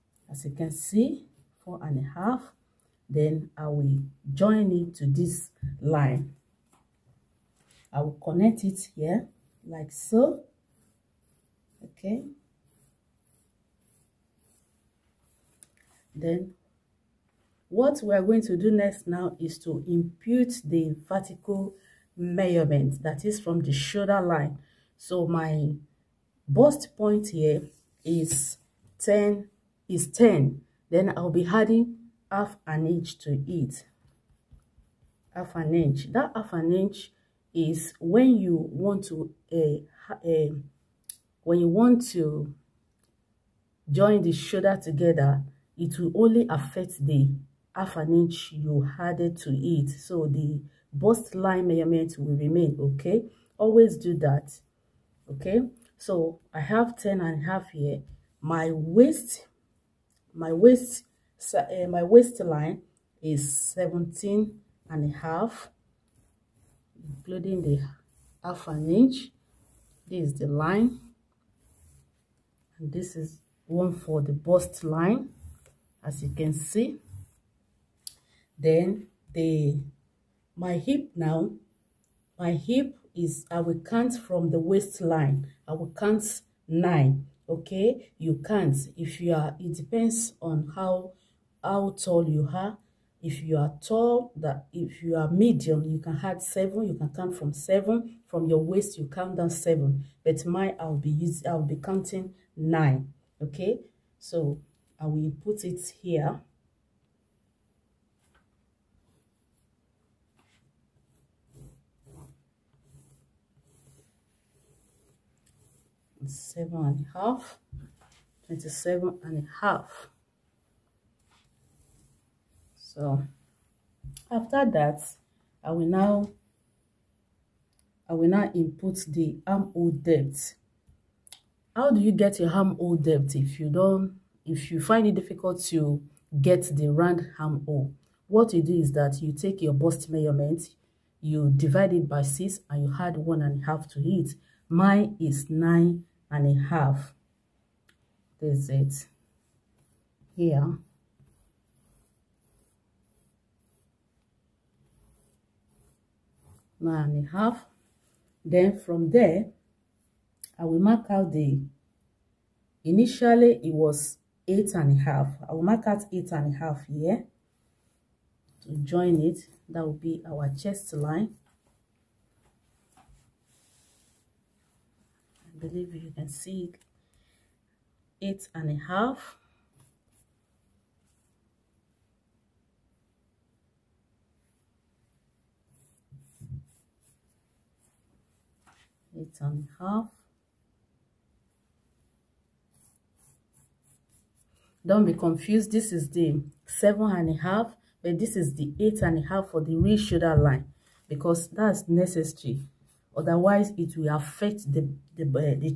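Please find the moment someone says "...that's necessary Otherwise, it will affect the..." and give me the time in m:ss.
3:21.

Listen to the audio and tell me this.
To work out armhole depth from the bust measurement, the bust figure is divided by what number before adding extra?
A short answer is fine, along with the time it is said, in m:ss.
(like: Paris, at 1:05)
6, at 2:22.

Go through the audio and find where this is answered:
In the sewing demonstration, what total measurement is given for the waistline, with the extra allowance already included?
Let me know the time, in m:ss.
1:03.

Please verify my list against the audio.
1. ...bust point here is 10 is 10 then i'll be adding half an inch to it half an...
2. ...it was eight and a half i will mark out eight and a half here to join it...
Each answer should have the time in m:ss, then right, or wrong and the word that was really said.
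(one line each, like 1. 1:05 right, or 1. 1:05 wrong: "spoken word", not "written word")
1. 0:26 right
2. 2:43 right.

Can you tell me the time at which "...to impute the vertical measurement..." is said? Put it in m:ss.
0:19.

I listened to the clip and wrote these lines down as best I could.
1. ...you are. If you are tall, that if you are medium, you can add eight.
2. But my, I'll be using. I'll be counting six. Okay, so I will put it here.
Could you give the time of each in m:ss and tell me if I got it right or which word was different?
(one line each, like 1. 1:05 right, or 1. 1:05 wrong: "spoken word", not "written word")
1. 1:32 wrong: "seven", not "eight"
2. 1:40 wrong: "nine", not "six".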